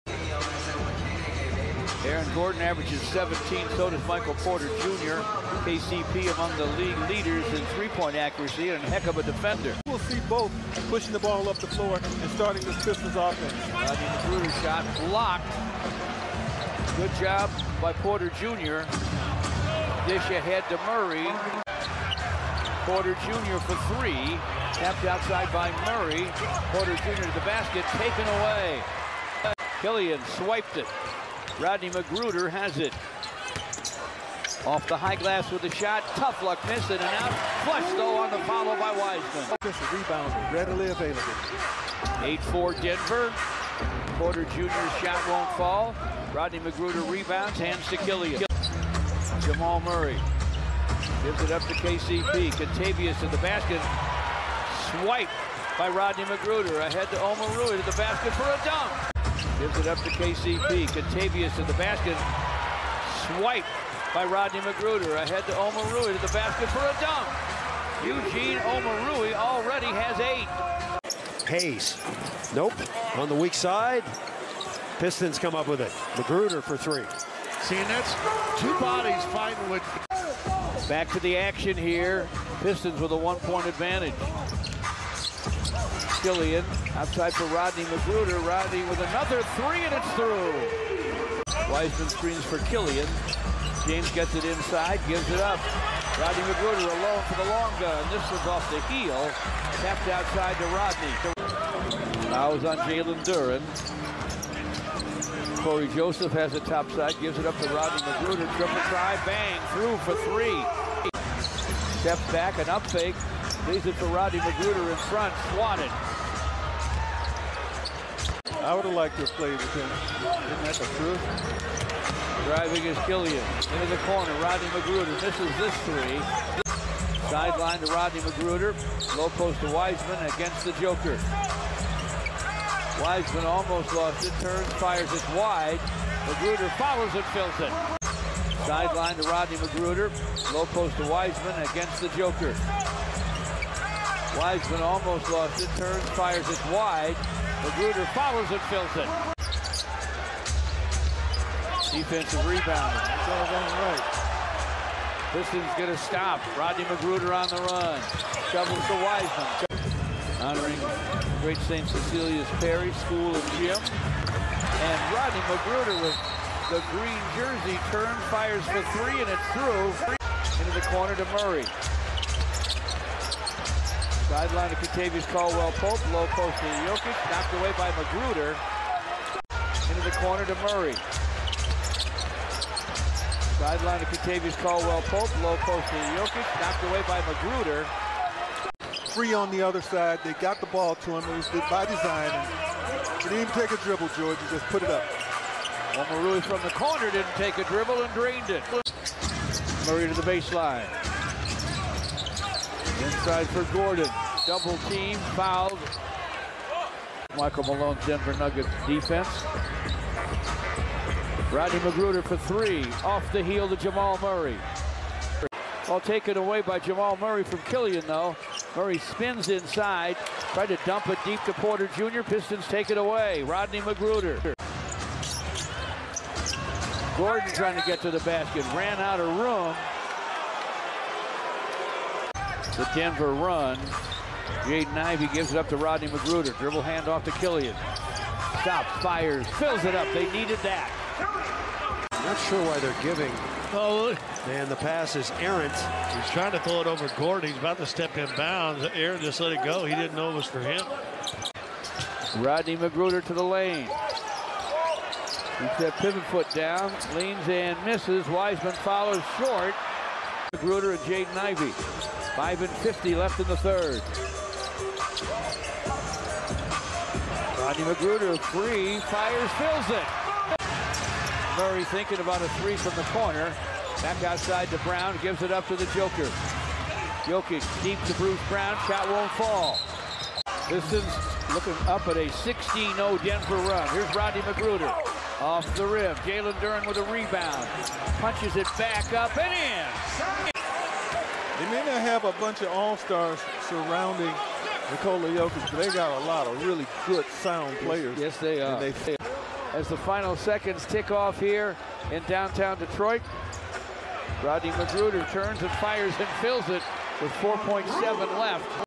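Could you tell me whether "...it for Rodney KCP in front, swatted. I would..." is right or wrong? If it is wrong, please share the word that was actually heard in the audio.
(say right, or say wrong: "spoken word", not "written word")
wrong: "McGruder", not "KCP".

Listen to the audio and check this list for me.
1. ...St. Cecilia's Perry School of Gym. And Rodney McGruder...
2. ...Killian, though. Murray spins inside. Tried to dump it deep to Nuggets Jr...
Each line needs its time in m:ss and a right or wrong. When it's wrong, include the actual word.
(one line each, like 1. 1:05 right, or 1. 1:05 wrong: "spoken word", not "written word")
1. 2:41 right
2. 3:37 wrong: "Porter", not "Nuggets".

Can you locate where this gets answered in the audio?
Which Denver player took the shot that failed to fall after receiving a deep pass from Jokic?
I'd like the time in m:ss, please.
4:38.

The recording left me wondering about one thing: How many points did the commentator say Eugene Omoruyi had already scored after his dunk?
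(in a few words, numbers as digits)
8.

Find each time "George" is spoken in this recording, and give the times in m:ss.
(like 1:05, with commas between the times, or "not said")
3:14.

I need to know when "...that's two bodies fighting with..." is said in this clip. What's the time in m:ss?
1:17.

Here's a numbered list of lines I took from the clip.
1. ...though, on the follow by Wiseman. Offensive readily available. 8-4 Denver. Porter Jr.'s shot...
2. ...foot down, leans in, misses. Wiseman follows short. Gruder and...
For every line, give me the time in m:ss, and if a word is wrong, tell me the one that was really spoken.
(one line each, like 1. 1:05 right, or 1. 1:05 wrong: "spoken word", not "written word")
1. 0:37 right
2. 4:16 right.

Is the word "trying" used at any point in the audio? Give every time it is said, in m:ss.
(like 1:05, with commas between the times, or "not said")
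3:47, 4:06.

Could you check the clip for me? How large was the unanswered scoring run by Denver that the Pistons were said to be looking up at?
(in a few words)
16-0.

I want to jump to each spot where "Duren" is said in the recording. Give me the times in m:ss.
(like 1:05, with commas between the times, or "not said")
1:43, 4:46.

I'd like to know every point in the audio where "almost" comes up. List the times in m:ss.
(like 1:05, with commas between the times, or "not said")
2:13, 2:24.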